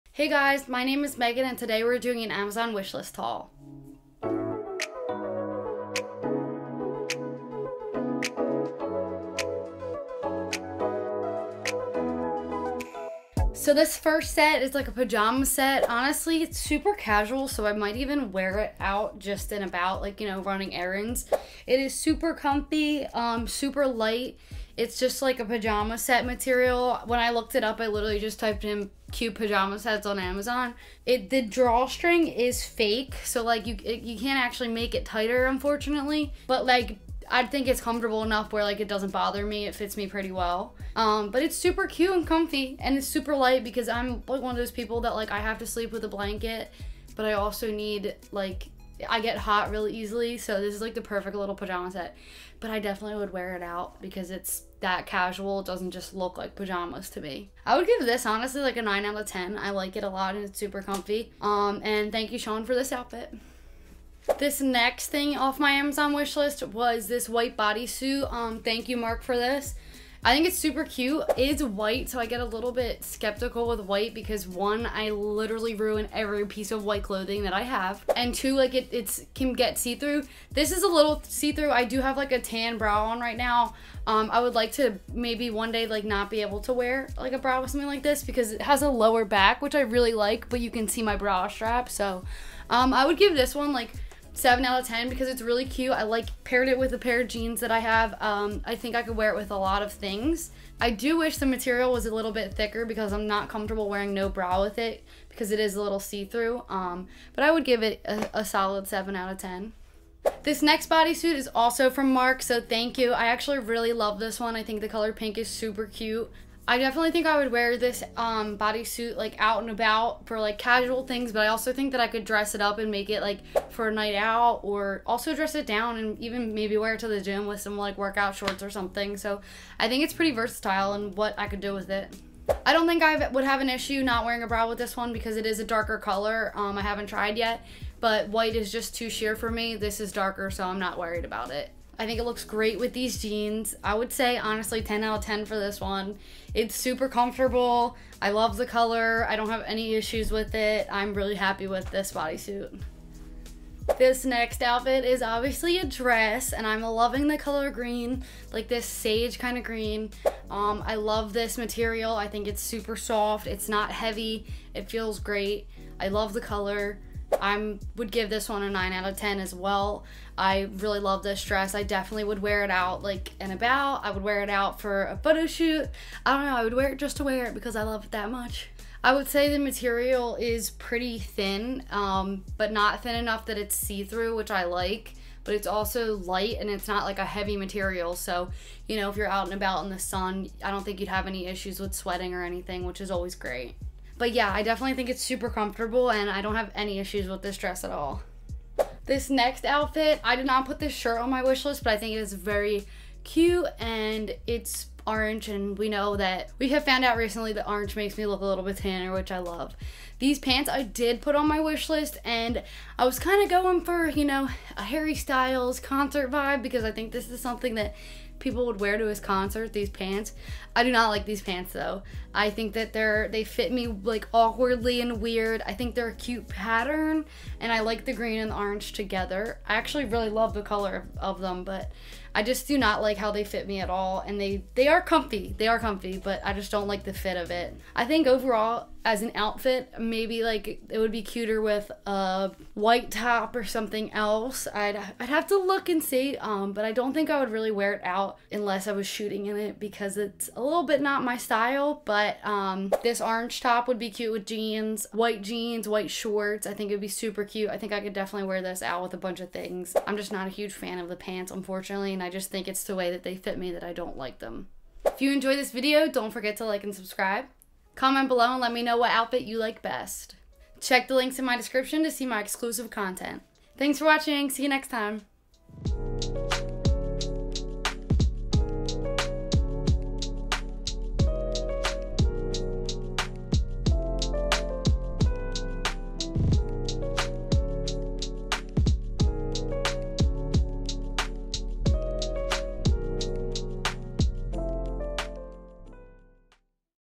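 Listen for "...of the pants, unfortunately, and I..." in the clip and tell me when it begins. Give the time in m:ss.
4:20.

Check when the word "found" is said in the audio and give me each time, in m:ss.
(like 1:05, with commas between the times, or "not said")
3:26.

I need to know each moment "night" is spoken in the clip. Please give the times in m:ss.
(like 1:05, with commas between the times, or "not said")
2:03.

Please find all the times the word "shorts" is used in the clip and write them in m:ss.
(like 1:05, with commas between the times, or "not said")
2:08, 4:16.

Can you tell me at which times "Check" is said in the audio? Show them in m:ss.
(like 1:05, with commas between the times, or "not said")
4:30.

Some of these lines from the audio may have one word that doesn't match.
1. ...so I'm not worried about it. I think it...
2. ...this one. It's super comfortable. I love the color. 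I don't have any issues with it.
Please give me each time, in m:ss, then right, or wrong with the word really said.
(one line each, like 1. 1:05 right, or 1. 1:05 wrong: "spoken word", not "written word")
1. 2:20 right
2. 2:25 right.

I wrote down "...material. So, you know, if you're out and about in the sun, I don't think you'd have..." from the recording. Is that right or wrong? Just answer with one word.
right.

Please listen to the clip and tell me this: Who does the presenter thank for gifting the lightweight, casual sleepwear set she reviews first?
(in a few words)
Sean.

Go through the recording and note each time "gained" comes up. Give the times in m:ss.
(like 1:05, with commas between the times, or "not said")
not said.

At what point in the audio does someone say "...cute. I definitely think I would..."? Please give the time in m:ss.
1:55.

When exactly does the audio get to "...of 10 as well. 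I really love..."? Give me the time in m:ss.
2:49.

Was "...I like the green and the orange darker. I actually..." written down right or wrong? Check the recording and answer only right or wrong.
wrong.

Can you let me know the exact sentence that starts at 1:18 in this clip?
And two, like it it's, can get see-through.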